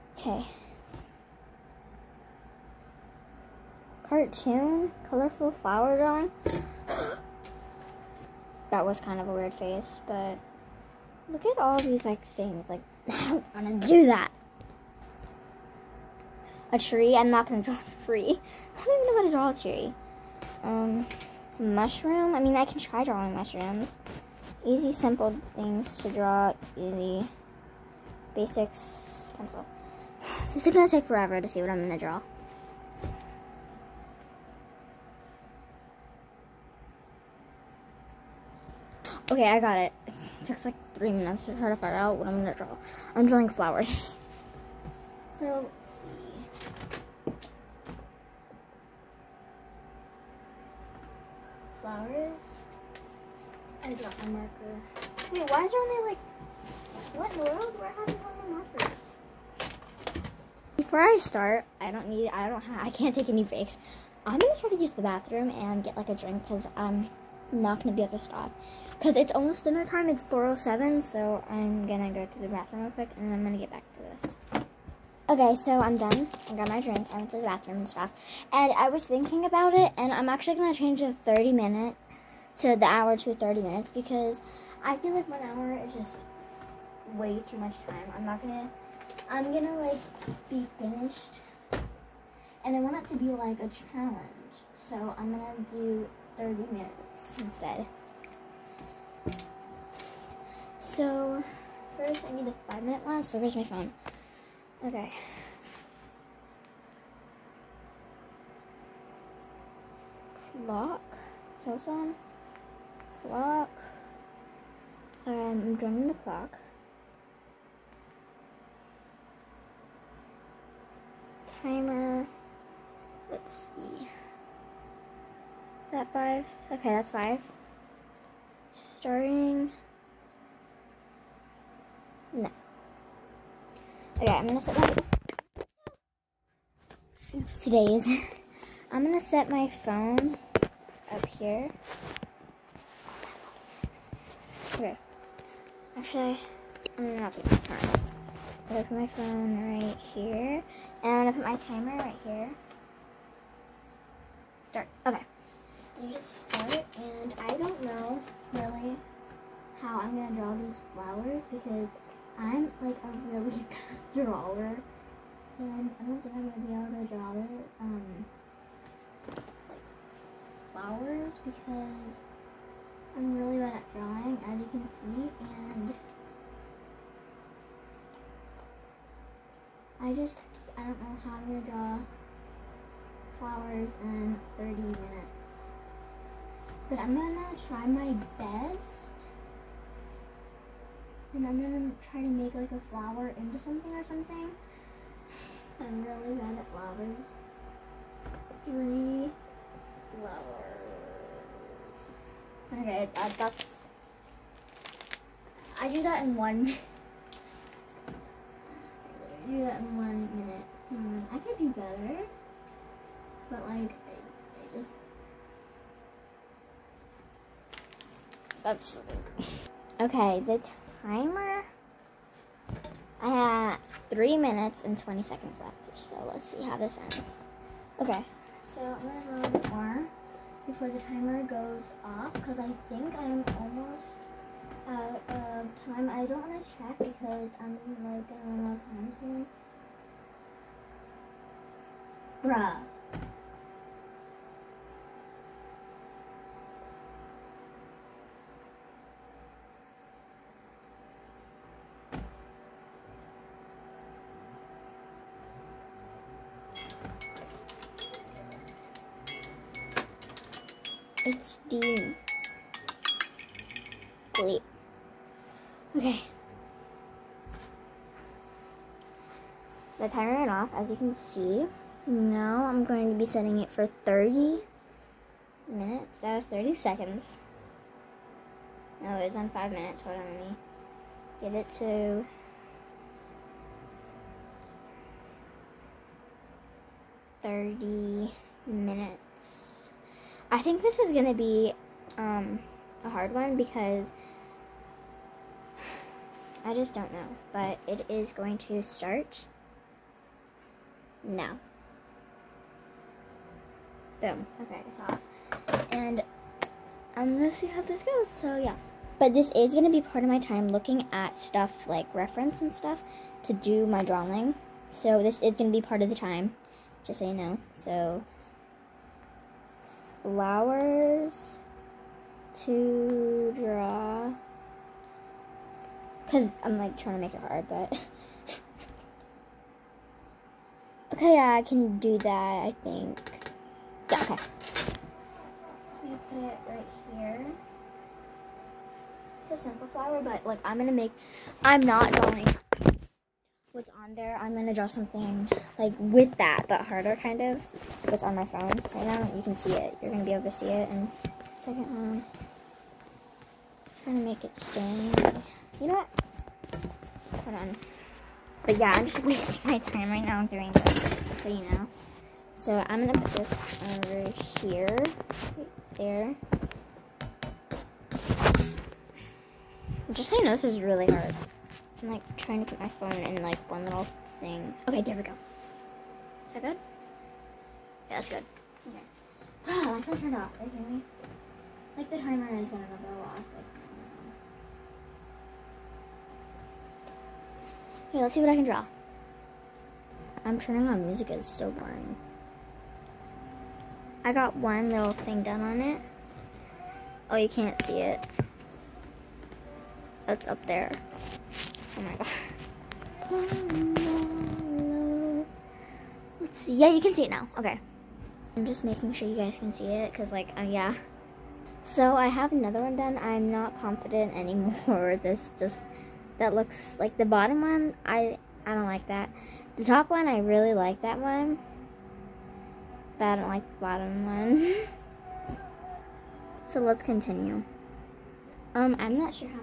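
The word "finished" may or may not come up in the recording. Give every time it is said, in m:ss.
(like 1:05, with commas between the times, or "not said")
1:30.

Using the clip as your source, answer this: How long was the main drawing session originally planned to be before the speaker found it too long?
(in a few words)
1 hour.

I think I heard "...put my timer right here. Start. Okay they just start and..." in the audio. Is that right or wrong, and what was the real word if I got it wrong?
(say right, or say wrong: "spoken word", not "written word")
right.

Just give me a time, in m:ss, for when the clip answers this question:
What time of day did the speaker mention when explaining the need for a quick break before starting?
1:10.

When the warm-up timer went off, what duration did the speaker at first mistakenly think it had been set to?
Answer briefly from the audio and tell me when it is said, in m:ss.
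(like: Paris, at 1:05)
30 seconds, at 4:36.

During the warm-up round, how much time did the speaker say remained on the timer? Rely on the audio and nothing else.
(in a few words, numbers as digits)
3 minutes 20 seconds.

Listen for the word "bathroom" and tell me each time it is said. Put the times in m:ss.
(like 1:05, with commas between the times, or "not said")
1:05, 1:12, 1:17.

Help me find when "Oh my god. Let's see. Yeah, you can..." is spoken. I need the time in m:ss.
6:42.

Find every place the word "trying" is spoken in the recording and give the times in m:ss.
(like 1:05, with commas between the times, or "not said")
5:26, 5:54, 6:12.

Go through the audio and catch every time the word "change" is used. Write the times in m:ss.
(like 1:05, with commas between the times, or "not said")
1:20.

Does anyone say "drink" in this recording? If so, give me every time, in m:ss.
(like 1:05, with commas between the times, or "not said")
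1:06, 1:16.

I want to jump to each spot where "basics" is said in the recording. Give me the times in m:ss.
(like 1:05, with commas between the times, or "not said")
0:28.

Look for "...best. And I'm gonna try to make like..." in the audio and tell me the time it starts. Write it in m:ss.
3:08.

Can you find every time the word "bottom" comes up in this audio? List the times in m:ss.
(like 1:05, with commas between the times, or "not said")
6:57, 7:03.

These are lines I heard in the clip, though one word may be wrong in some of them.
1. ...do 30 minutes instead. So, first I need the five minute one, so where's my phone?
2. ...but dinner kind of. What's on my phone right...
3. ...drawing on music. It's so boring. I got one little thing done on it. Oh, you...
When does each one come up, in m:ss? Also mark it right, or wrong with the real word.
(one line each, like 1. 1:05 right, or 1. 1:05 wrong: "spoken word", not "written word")
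1. 1:35 right
2. 5:46 wrong: "harder", not "dinner"
3. 6:30 wrong: "turning", not "drawing".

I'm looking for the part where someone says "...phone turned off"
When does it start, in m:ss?
6:20.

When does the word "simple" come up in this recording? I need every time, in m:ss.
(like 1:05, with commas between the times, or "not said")
0:24, 5:39.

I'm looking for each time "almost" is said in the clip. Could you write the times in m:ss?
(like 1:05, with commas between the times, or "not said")
1:09, 3:53.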